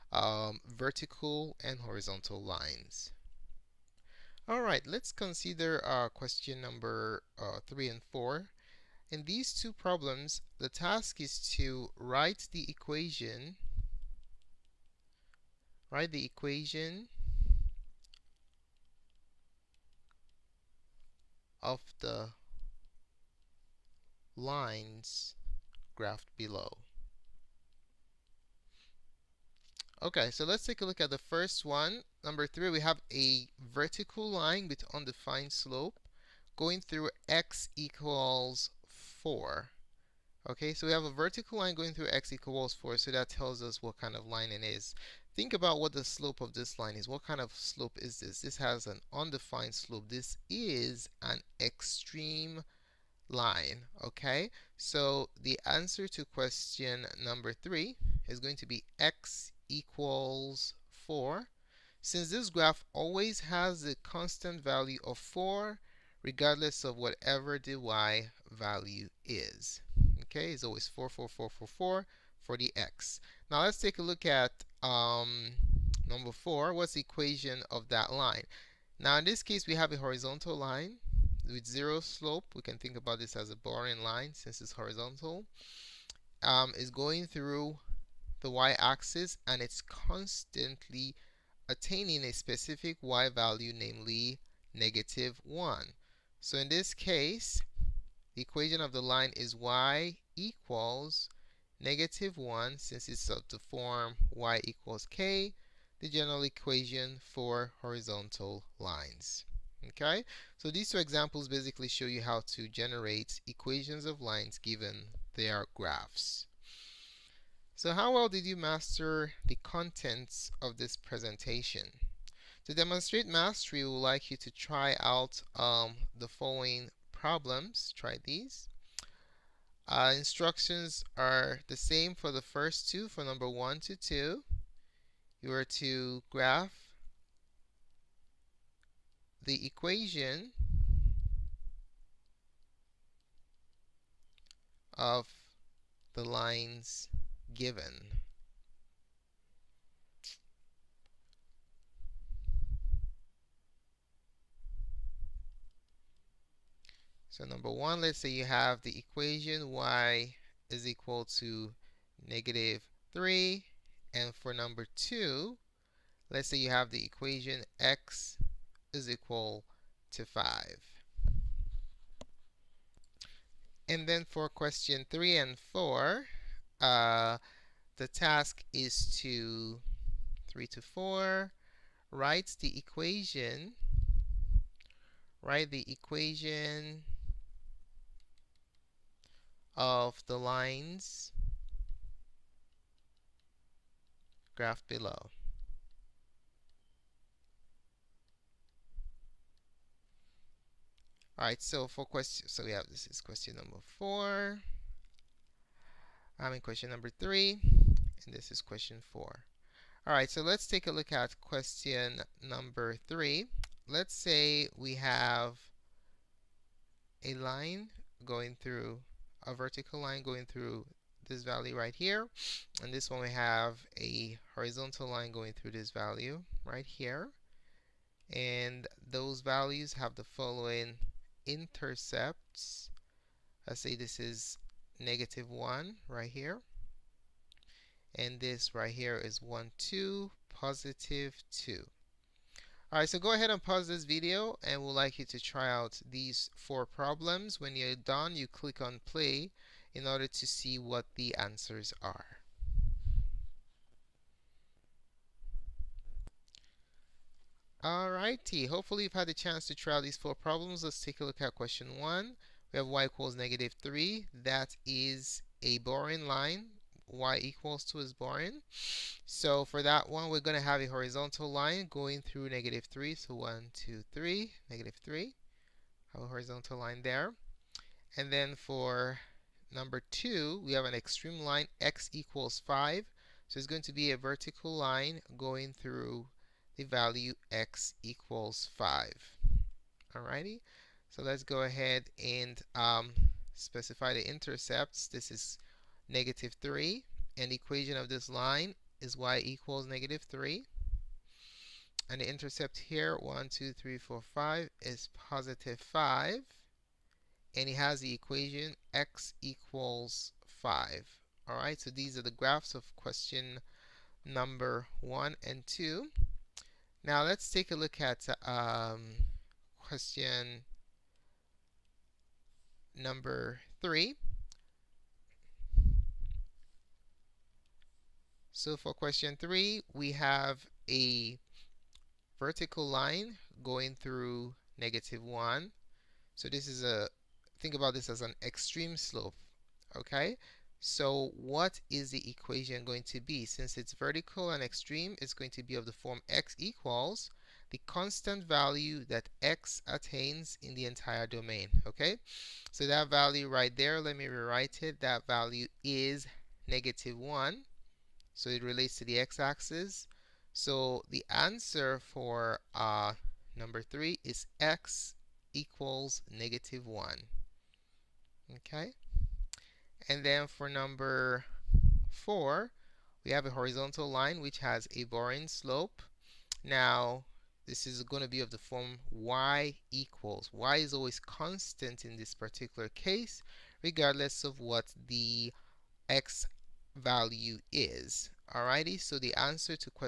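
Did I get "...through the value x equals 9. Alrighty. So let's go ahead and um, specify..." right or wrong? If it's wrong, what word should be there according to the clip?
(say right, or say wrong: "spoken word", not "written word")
wrong: "5", not "9".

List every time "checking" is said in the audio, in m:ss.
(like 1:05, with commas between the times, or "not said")
not said.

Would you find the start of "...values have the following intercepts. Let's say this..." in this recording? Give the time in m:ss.
3:49.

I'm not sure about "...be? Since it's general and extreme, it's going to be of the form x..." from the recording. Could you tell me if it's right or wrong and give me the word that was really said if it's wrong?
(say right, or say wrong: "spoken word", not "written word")
wrong: "vertical", not "general".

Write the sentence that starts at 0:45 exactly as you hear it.
Think about what the slope of this line is.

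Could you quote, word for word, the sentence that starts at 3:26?
I'm in question number three, and this is question four.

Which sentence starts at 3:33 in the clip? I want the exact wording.
Let's say we have a line going through, a vertical line going through this value right here.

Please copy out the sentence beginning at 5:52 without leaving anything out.
So that value right there, let me rewrite it, that value is negative 1, so it relates to the x-axis.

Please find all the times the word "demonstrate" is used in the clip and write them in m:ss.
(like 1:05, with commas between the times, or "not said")
2:02.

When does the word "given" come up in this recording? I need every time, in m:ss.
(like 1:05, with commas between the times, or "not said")
1:54, 2:27.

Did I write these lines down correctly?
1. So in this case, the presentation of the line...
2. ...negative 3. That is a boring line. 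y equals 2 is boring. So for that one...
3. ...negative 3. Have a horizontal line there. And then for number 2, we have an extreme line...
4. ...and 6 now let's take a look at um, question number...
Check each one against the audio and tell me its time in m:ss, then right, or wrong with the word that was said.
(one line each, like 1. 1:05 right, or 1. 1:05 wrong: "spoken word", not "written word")
1. 1:36 wrong: "equation", not "presentation"
2. 4:23 right
3. 4:34 right
4. 5:15 wrong: "2", not "6".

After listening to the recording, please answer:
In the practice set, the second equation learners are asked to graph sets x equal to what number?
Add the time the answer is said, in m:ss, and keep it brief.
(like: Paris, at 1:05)
5, at 2:47.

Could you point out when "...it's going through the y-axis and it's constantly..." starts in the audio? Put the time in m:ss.
1:26.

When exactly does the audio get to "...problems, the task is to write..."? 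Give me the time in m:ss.
0:09.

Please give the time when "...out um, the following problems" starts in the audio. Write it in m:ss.
2:05.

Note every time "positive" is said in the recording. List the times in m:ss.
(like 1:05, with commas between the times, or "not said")
4:00, 5:05.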